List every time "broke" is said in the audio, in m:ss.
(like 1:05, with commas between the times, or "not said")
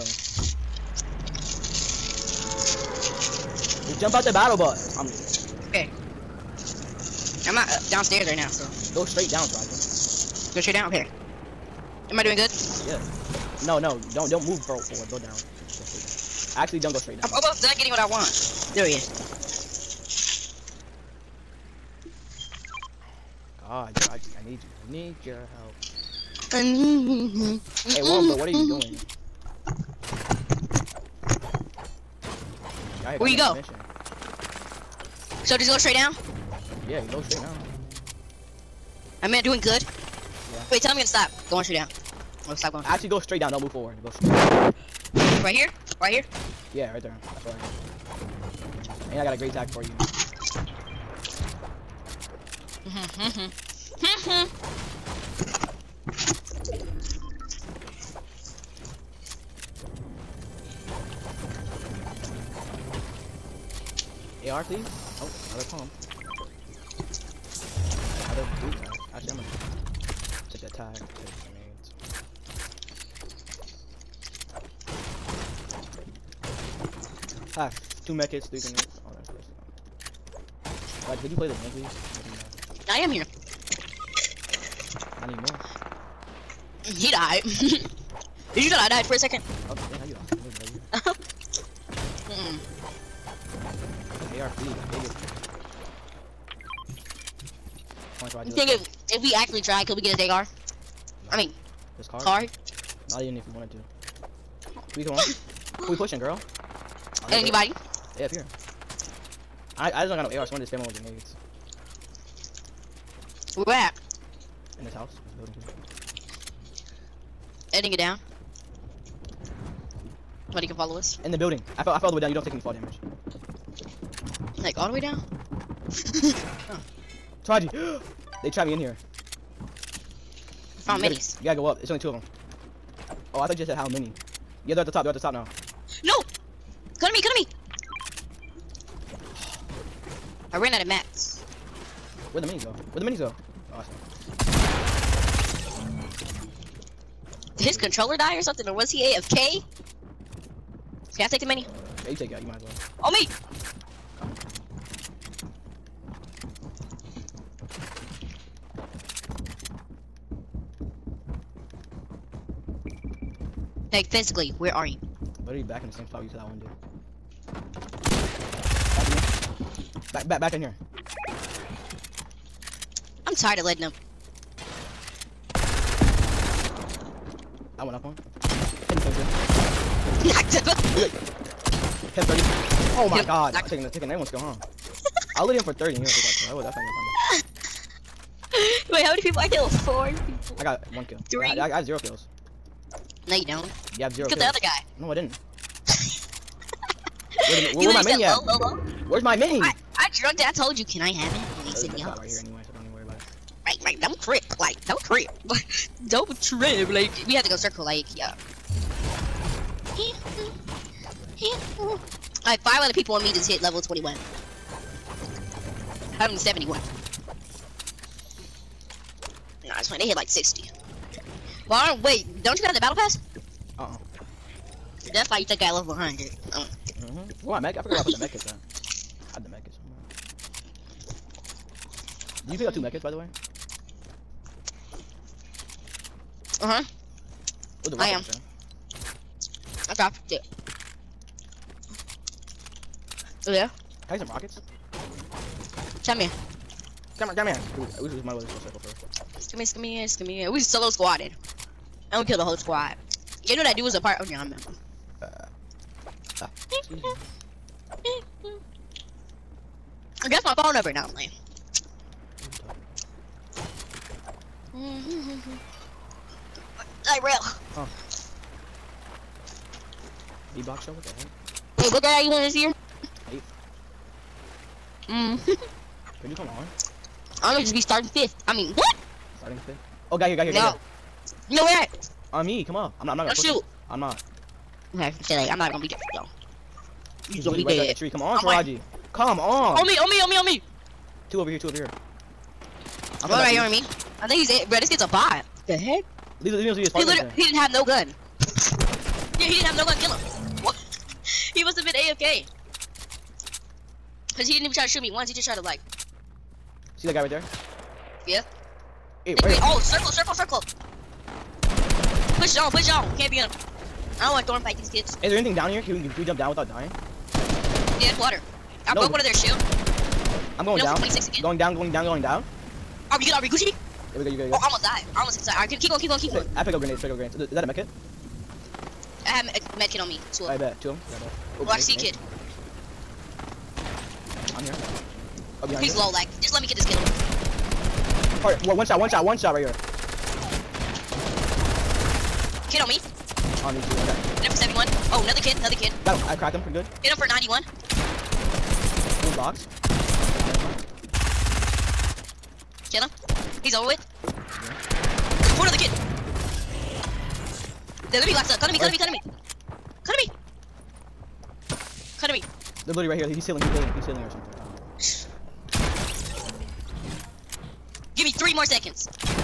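5:19.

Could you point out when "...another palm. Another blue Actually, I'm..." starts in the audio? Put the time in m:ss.
1:05.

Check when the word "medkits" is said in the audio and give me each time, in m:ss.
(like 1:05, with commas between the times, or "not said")
1:18, 5:27.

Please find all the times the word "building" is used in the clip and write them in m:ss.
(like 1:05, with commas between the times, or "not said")
1:55, 2:01.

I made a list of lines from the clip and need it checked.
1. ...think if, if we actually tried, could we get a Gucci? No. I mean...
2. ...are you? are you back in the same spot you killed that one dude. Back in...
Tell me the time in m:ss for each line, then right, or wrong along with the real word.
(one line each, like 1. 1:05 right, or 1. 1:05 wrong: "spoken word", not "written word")
1. 1:38 wrong: "Dagar", not "Gucci"
2. 2:44 right.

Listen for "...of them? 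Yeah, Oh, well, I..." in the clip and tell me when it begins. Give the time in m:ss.
5:30.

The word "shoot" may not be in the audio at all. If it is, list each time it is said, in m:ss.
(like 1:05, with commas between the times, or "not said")
4:43, 5:04.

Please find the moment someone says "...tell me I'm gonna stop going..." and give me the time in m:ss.
0:40.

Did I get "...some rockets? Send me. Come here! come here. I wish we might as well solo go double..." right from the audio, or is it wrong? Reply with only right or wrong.
wrong.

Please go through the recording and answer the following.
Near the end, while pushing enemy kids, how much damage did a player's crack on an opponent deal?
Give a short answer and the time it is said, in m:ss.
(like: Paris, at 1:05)
91, at 5:47.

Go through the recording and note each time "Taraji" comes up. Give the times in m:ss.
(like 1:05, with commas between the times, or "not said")
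0:09, 0:23, 2:07, 4:48.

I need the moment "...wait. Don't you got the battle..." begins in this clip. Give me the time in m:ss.
3:42.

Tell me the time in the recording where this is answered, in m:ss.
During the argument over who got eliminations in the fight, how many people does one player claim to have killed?
3:09.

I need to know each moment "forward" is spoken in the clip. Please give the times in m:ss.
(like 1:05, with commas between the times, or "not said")
0:14, 0:43.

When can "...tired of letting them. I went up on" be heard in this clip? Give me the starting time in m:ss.
2:53.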